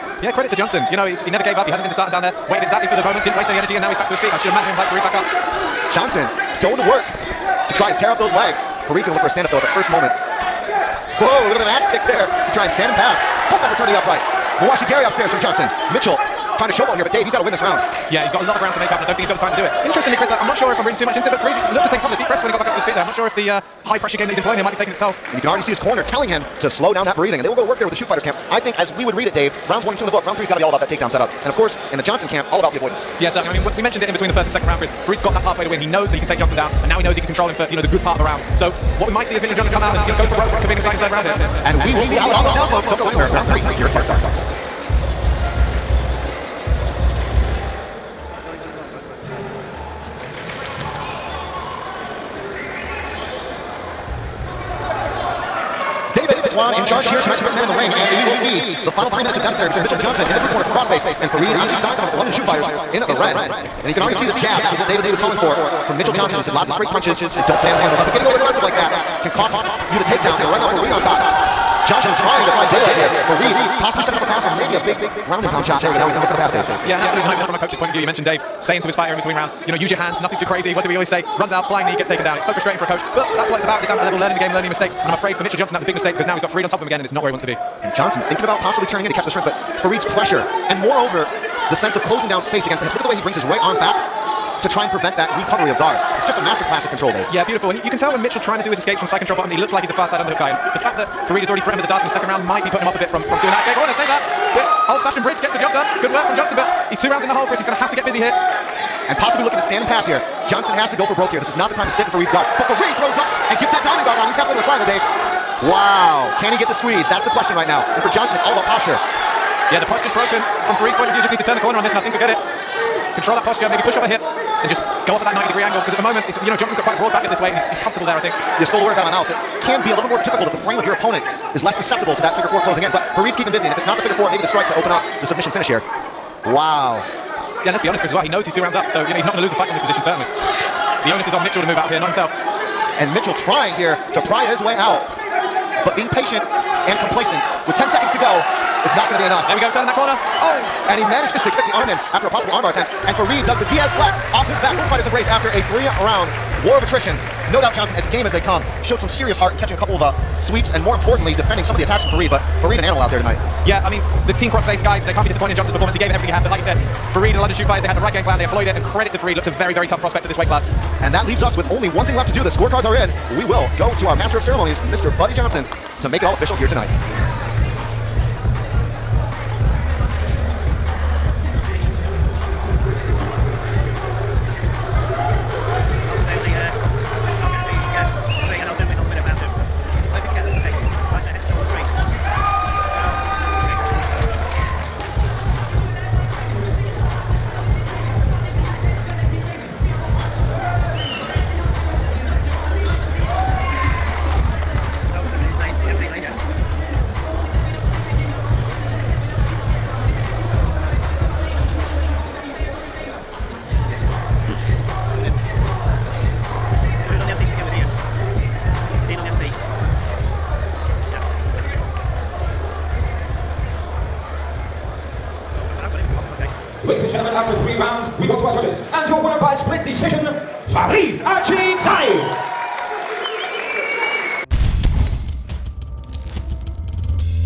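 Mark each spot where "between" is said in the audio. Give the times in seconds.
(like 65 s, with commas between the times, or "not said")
34 s, 59 s, 79 s.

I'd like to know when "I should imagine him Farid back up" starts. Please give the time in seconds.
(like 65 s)
4 s.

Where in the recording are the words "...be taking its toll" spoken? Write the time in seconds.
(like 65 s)
24 s.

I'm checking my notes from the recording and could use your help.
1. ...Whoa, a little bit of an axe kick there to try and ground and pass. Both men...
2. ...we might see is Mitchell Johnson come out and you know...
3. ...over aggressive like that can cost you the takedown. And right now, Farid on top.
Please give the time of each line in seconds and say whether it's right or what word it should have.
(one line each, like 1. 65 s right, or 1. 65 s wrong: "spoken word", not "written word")
1. 11 s wrong: "stand", not "ground"
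2. 39 s right
3. 68 s right.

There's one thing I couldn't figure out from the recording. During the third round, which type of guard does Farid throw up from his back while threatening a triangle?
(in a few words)
Diamond guard.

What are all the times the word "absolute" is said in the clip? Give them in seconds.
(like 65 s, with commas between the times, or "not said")
77 s.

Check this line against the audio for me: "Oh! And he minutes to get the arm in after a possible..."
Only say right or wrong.
wrong.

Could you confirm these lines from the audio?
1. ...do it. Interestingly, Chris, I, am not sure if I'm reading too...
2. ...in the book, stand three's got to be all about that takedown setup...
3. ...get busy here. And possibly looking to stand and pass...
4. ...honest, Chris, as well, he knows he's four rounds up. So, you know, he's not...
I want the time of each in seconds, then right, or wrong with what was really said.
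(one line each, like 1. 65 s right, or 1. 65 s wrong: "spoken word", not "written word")
1. 19 s right
2. 30 s wrong: "round", not "stand"
3. 107 s right
4. 137 s wrong: "two", not "four".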